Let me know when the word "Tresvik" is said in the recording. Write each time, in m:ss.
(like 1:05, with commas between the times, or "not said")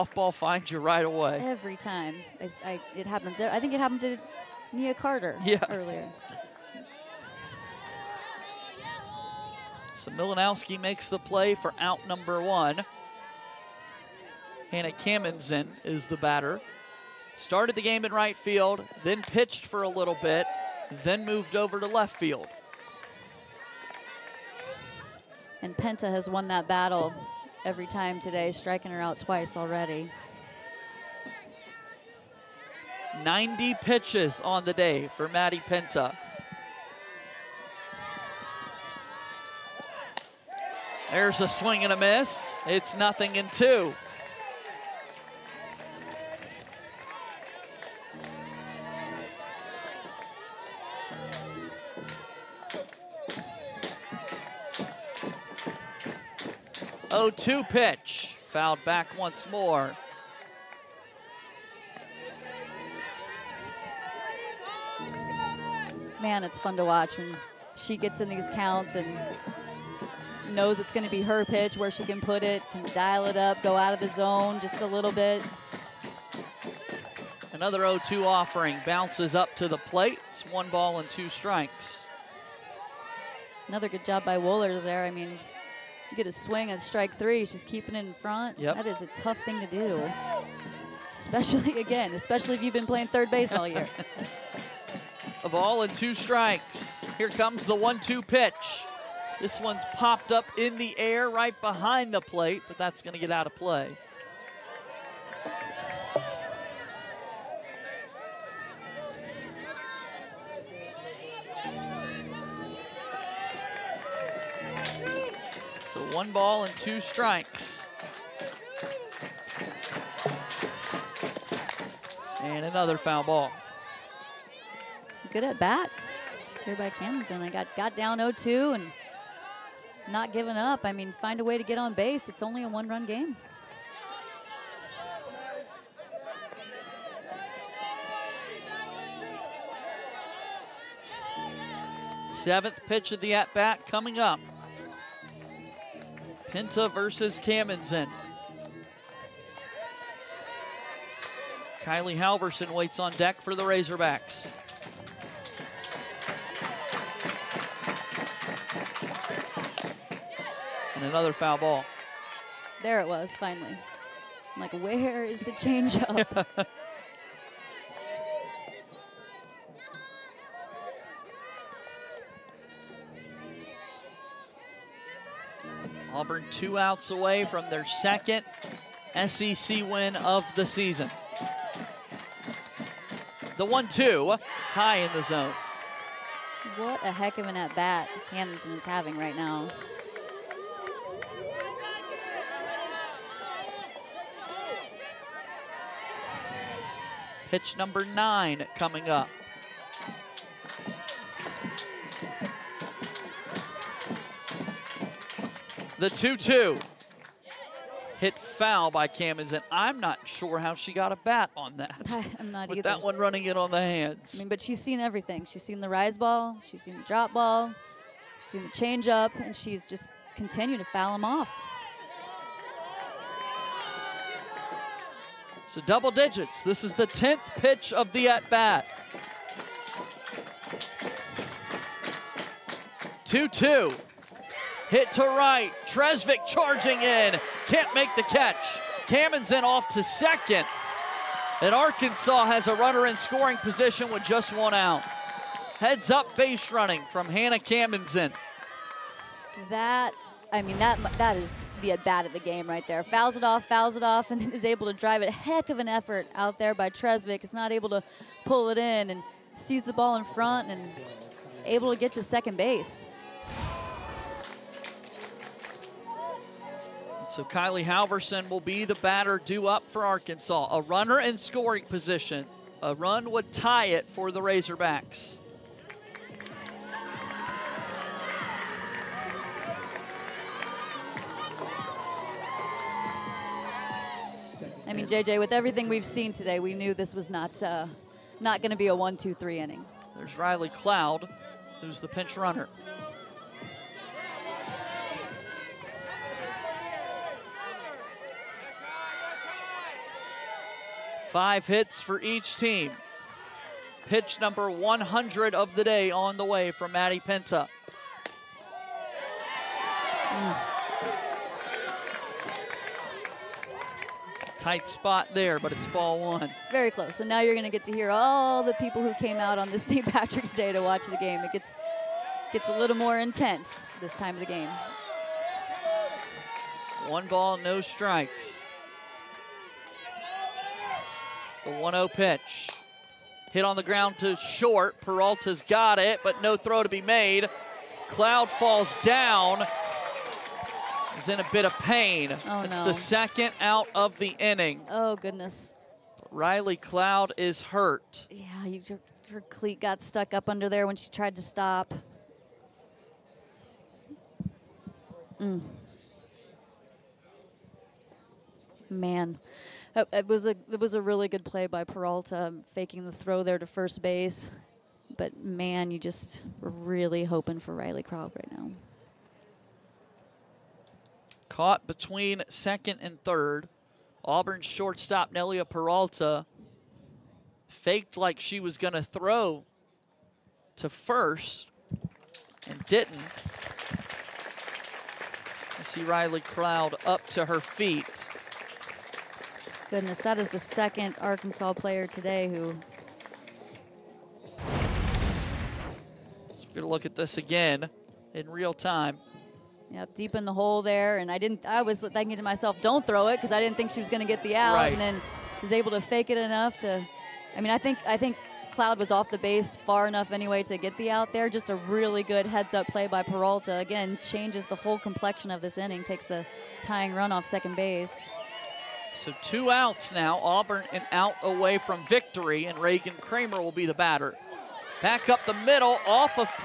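3:55, 4:16.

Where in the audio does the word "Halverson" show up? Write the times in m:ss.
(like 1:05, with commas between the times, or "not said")
2:32, 4:27.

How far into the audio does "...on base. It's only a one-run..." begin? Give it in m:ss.
2:11.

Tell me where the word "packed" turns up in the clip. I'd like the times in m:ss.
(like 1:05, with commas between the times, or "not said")
not said.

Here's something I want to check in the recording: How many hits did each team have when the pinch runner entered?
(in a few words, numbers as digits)
5.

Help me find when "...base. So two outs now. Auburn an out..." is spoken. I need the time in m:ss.
6:57.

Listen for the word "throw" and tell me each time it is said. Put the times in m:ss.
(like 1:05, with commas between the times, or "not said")
5:36, 6:03, 6:19, 6:43.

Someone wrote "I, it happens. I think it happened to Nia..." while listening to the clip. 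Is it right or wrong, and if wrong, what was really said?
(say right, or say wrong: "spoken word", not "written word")
right.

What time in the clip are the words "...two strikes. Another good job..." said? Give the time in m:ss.
1:21.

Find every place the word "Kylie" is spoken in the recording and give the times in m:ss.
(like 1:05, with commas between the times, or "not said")
2:31, 4:27.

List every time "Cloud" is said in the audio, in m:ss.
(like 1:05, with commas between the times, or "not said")
4:50, 5:38, 5:46, 6:08, 6:26, 6:48.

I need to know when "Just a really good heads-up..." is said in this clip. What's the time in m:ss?
6:51.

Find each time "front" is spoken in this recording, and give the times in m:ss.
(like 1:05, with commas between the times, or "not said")
1:28, 4:20.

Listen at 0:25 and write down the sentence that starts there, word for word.
And Penta has won that battle every time today, striking her out twice already.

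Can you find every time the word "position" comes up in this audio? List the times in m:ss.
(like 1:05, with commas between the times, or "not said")
4:03, 4:31.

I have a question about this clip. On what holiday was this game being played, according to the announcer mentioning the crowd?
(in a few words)
St. Patrick's Day.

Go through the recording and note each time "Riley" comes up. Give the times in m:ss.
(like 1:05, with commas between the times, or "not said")
4:50, 5:46, 6:07, 6:26.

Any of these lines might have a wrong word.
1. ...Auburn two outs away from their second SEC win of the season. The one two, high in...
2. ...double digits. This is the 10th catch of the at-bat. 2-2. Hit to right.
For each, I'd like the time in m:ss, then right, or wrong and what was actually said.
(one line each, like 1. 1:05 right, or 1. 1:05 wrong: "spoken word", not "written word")
1. 2:56 right
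2. 3:45 wrong: "pitch", not "catch".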